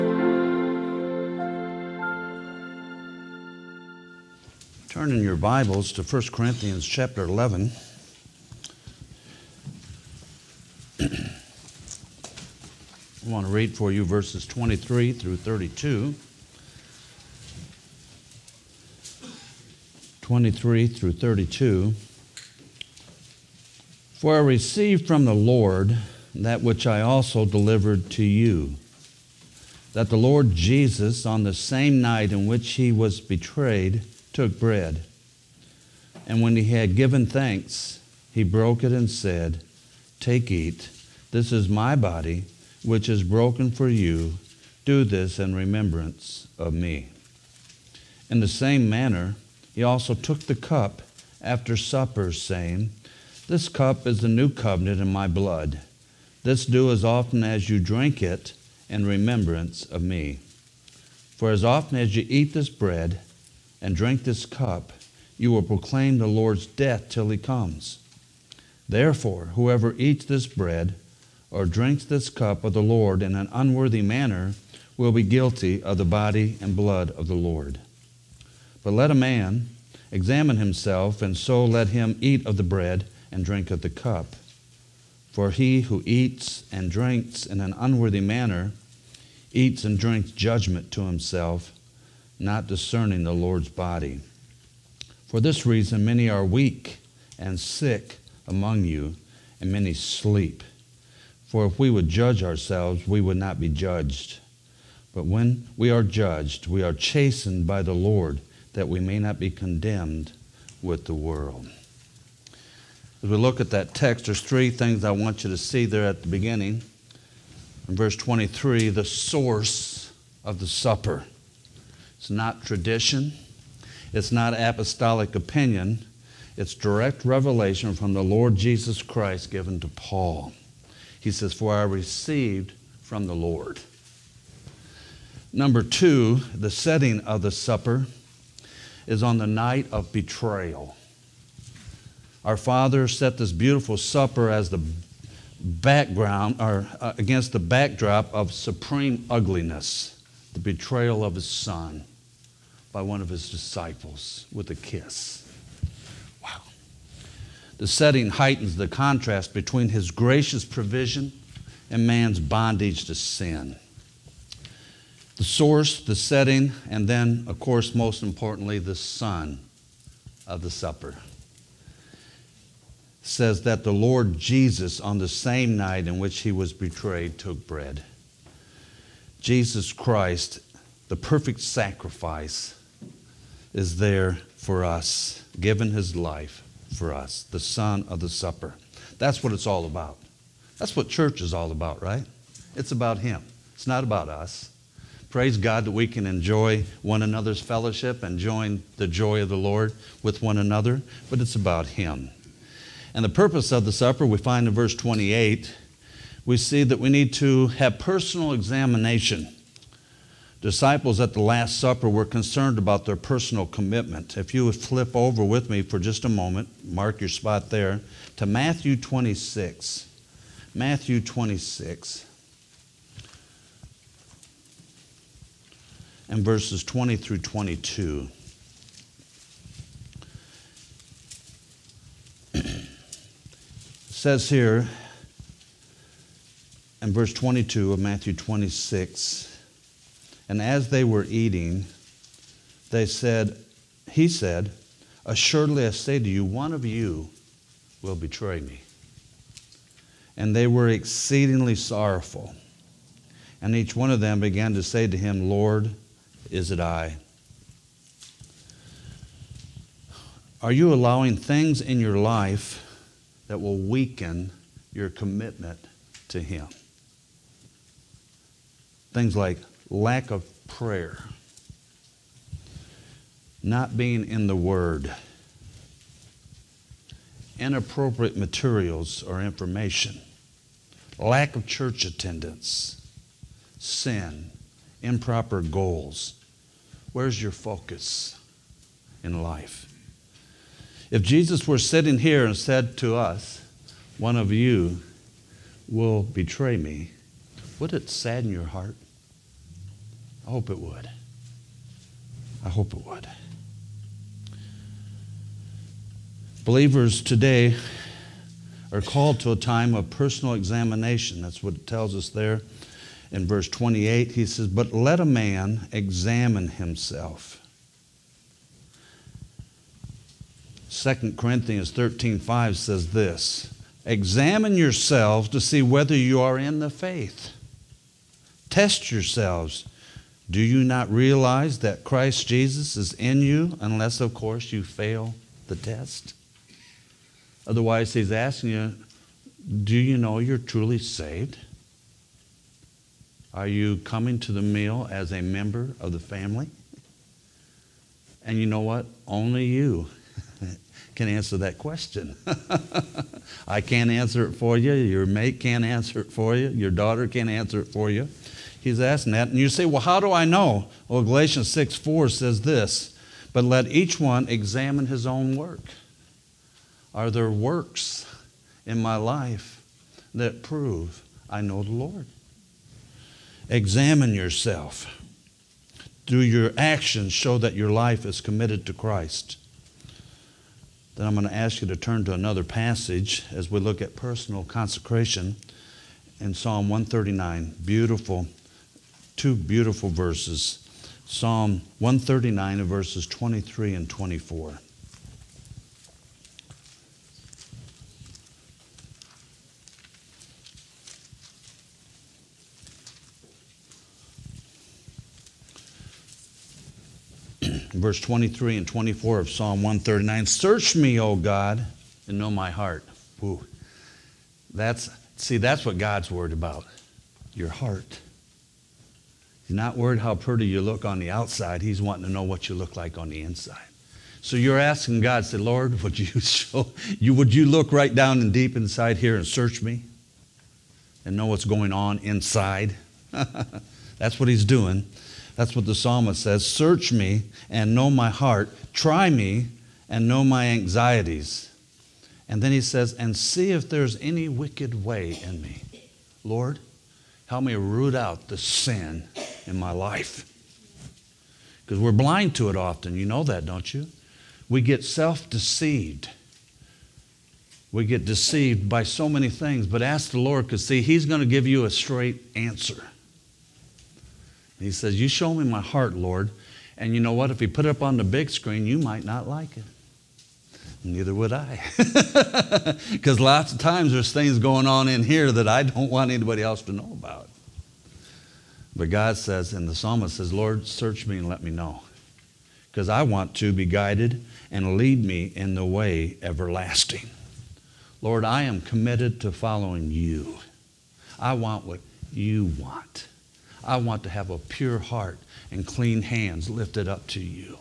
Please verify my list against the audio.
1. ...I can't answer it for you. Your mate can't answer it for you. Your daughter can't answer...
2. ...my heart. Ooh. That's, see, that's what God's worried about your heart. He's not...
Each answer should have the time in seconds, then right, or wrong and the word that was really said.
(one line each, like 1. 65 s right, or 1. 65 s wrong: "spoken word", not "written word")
1. 353 s right
2. 412 s right.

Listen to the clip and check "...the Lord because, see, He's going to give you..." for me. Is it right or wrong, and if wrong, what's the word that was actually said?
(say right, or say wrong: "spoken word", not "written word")
right.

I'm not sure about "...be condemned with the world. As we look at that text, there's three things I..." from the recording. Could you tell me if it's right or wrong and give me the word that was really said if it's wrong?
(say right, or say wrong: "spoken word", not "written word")
right.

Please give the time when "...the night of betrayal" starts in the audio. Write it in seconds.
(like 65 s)
139 s.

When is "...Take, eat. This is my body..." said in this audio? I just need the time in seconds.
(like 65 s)
40 s.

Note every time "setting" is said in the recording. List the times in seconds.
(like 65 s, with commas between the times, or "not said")
136 s, 157 s, 166 s.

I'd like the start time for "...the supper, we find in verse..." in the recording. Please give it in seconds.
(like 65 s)
203 s.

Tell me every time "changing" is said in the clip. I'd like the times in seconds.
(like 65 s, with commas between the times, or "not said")
not said.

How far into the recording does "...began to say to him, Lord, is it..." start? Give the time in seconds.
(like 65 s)
254 s.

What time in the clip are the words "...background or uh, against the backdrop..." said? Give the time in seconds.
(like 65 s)
145 s.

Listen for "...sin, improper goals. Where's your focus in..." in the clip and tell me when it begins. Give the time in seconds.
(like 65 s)
283 s.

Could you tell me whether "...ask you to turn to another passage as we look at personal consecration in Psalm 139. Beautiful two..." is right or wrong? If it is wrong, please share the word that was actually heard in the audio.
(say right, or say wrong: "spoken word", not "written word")
right.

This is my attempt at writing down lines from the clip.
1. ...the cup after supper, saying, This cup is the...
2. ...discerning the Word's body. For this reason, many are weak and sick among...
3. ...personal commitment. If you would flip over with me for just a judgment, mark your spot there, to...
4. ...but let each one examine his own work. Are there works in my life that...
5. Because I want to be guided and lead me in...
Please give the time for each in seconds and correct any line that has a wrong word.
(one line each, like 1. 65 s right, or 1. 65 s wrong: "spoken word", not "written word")
1. 50 s right
2. 92 s wrong: "Lord", not "Word"
3. 213 s wrong: "moment", not "judgment"
4. 363 s right
5. 482 s right.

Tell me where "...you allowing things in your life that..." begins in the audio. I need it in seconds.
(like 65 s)
260 s.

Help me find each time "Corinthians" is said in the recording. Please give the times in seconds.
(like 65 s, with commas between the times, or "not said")
6 s, 321 s.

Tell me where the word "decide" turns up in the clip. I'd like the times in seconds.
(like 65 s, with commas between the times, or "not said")
not said.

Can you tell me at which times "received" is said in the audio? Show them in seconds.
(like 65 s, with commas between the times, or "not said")
24 s, 131 s.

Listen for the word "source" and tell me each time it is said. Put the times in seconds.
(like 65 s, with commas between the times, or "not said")
119 s, 165 s.